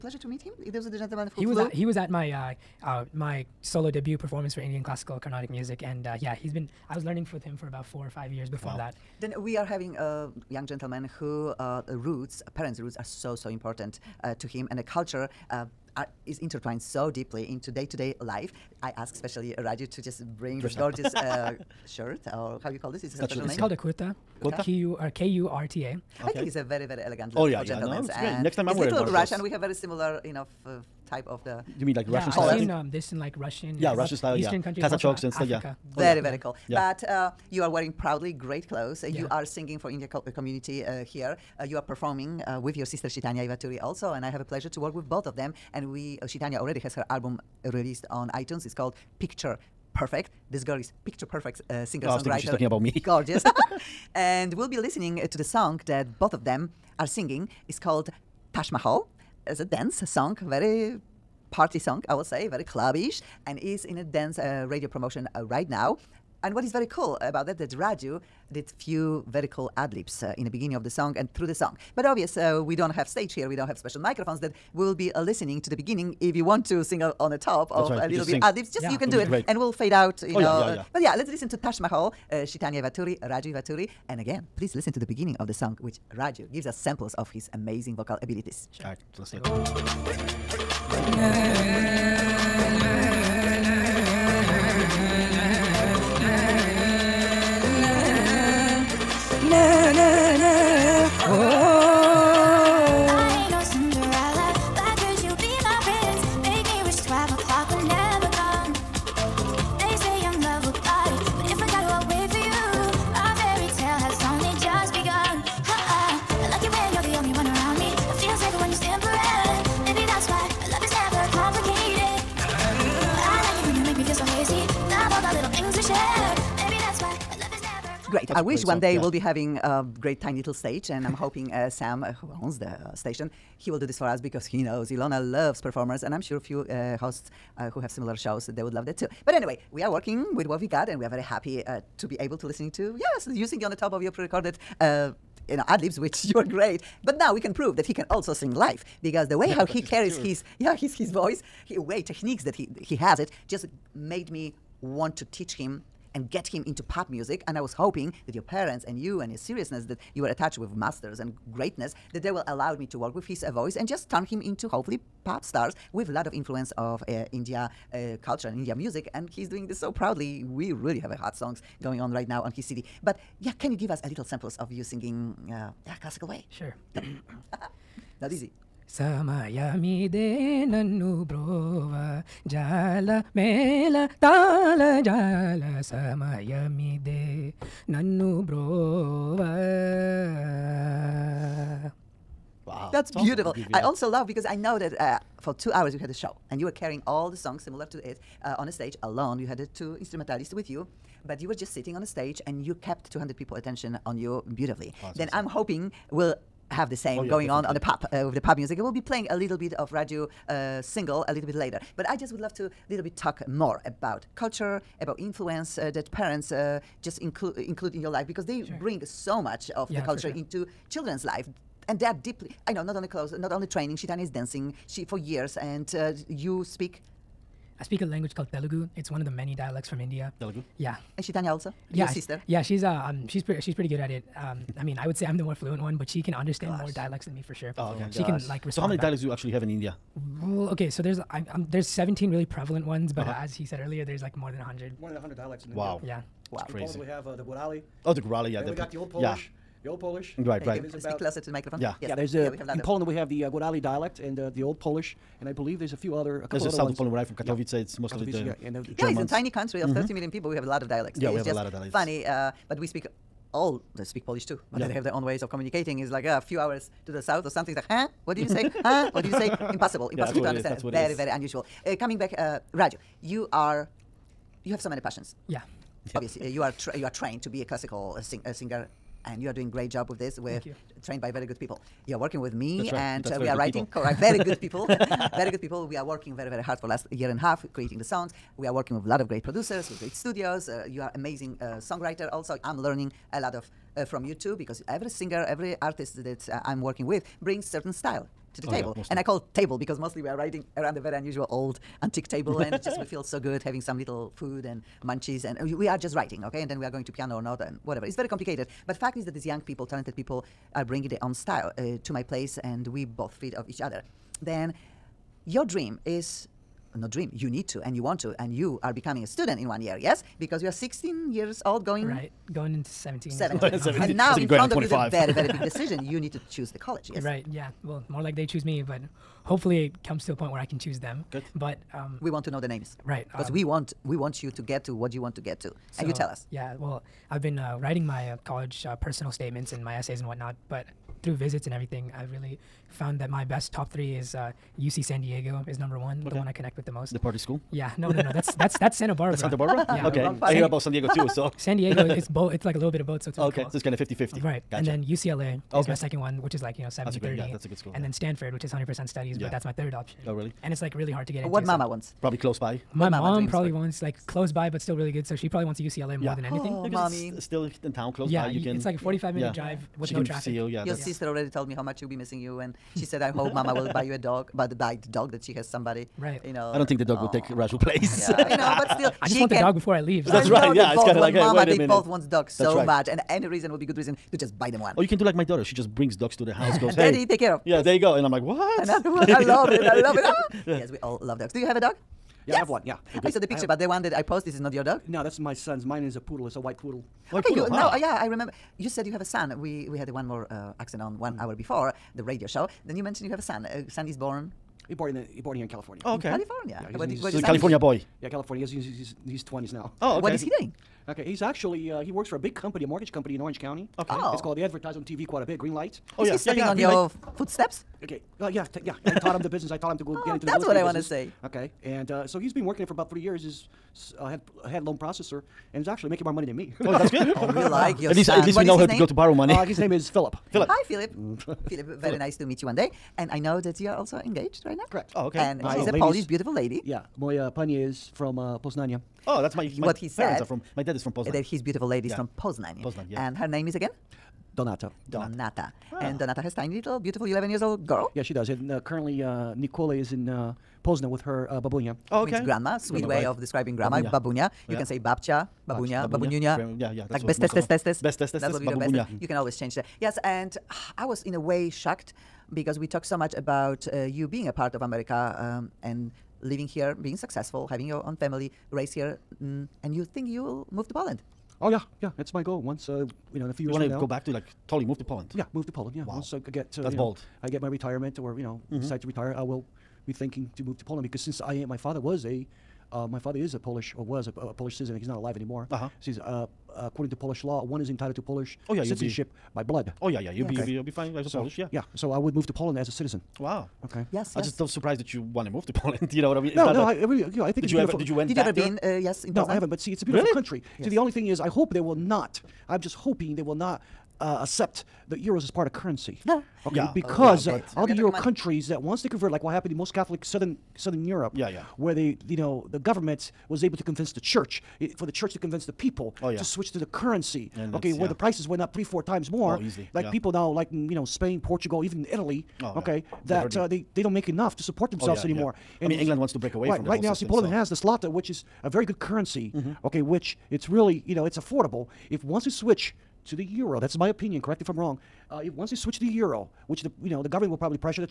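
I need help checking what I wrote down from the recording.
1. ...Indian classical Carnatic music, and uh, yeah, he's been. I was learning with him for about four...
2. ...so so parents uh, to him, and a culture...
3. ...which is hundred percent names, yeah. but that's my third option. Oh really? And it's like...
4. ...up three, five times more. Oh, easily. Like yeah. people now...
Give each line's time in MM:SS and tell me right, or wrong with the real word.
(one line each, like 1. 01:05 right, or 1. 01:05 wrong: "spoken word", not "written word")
1. 00:04 right
2. 00:13 wrong: "important", not "parents"
3. 05:58 wrong: "studies", not "names"
4. 08:38 wrong: "four", not "five".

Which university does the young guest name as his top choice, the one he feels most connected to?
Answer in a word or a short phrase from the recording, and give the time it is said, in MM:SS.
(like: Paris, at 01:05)
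UC San Diego, at 05:44.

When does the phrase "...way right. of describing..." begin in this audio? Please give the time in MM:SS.
07:33.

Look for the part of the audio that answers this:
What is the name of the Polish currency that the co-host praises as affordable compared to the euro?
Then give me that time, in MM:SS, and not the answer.
08:47.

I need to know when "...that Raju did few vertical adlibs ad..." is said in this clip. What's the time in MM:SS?
01:07.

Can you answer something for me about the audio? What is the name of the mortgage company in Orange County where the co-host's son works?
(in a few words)
Green Light.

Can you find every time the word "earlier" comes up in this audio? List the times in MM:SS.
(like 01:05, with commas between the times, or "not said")
04:03.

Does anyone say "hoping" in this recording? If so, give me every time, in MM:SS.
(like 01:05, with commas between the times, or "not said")
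02:11, 02:37, 03:25, 08:22.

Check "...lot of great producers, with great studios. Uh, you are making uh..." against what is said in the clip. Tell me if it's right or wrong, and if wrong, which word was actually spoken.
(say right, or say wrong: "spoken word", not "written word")
wrong: "amazing", not "making".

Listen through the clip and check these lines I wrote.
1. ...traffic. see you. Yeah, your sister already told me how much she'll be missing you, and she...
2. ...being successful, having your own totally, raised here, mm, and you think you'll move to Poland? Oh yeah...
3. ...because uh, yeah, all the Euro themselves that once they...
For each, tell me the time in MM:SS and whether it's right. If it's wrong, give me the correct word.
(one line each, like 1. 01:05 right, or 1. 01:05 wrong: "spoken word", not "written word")
1. 06:10 right
2. 07:46 wrong: "family", not "totally"
3. 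08:26 wrong: "countries", not "themselves".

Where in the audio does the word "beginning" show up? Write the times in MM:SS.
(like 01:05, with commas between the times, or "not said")
01:10, 01:15, 01:25.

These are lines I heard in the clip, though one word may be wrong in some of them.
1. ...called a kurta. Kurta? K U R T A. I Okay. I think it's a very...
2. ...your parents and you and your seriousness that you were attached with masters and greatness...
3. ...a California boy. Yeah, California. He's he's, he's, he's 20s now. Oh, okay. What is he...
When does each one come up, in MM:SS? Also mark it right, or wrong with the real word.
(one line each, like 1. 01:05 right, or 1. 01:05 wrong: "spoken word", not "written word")
1. 00:23 right
2. 02:38 right
3. 06:47 right.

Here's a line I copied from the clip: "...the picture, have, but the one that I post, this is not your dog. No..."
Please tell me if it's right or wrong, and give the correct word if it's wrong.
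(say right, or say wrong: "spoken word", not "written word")
right.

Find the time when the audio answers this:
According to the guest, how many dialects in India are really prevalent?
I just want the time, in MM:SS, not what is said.
04:01.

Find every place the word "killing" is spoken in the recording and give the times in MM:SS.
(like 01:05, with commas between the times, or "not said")
not said.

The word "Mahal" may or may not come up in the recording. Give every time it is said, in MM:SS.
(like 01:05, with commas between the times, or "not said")
00:58, 01:21.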